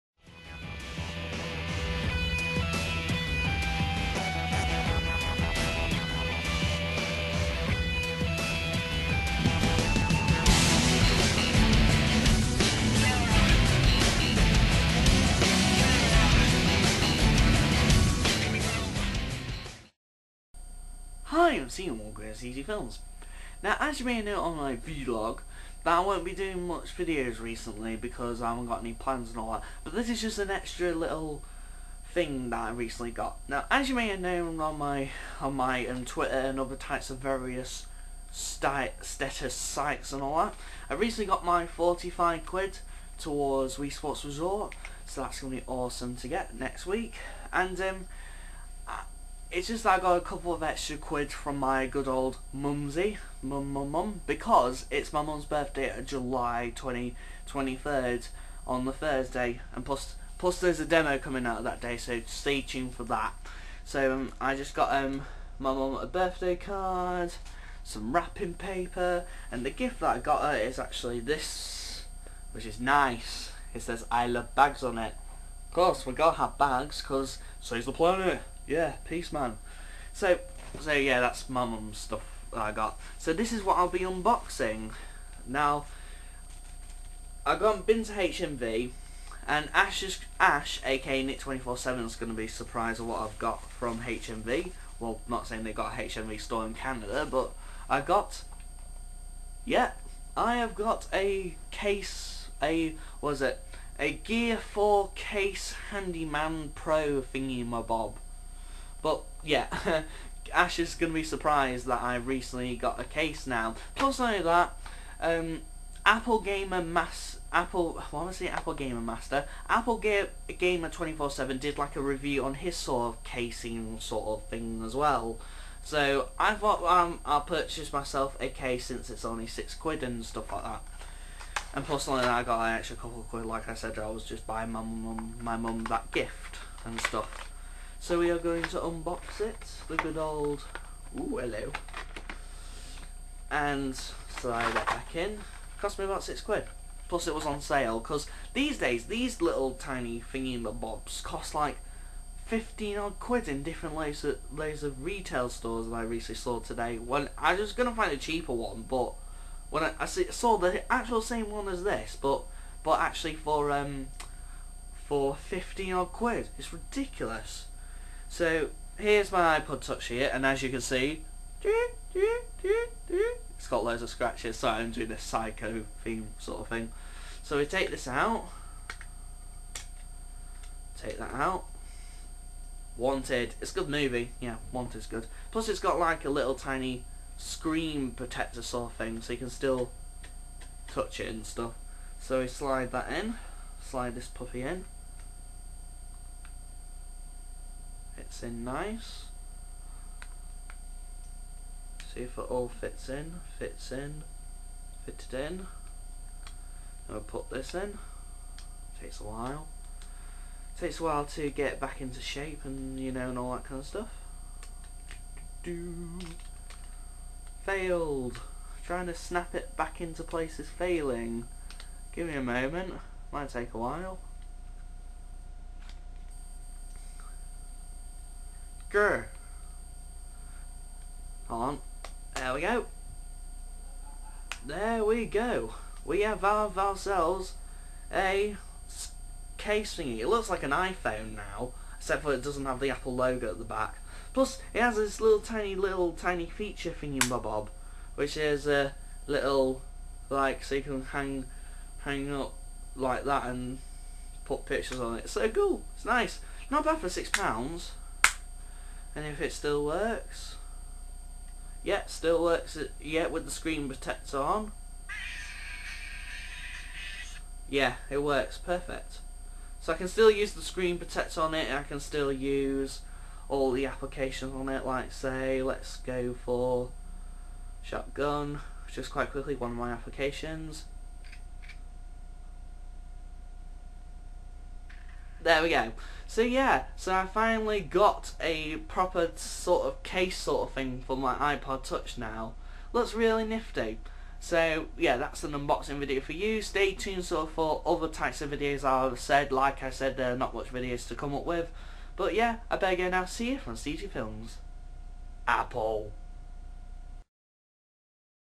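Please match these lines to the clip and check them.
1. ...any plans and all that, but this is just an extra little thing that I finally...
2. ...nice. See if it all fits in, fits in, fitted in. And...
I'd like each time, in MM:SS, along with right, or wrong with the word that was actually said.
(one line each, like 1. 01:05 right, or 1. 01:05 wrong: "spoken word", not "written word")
1. 00:28 wrong: "recently", not "finally"
2. 03:18 right.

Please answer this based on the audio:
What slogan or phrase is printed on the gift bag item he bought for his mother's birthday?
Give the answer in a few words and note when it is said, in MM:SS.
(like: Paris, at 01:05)
I love bags, at 01:14.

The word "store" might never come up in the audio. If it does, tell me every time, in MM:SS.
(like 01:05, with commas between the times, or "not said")
01:36, 02:35.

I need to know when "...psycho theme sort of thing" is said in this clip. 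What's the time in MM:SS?
02:55.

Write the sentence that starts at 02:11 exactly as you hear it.
And plus, like that, I got an extra couple of quid.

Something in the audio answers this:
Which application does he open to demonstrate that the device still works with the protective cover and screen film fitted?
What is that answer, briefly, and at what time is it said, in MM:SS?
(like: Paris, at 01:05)
Shotgun, at 04:37.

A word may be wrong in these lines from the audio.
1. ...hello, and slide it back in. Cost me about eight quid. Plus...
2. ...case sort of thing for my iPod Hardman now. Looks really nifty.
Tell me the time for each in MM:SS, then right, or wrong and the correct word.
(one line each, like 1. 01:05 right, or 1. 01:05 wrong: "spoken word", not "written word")
1. 02:21 wrong: "six", not "eight"
2. 04:50 wrong: "Touch", not "Hardman".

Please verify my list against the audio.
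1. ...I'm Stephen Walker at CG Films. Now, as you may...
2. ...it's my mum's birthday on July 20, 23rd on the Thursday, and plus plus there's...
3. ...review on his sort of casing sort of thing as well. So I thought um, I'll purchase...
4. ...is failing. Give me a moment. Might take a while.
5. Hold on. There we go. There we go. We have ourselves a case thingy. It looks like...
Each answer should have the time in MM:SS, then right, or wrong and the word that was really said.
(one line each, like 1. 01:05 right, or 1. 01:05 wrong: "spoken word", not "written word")
1. 00:21 right
2. 00:54 right
3. 02:02 right
4. 03:40 right
5. 03:51 right.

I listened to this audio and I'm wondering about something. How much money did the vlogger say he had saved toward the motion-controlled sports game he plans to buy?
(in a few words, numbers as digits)
45 quid.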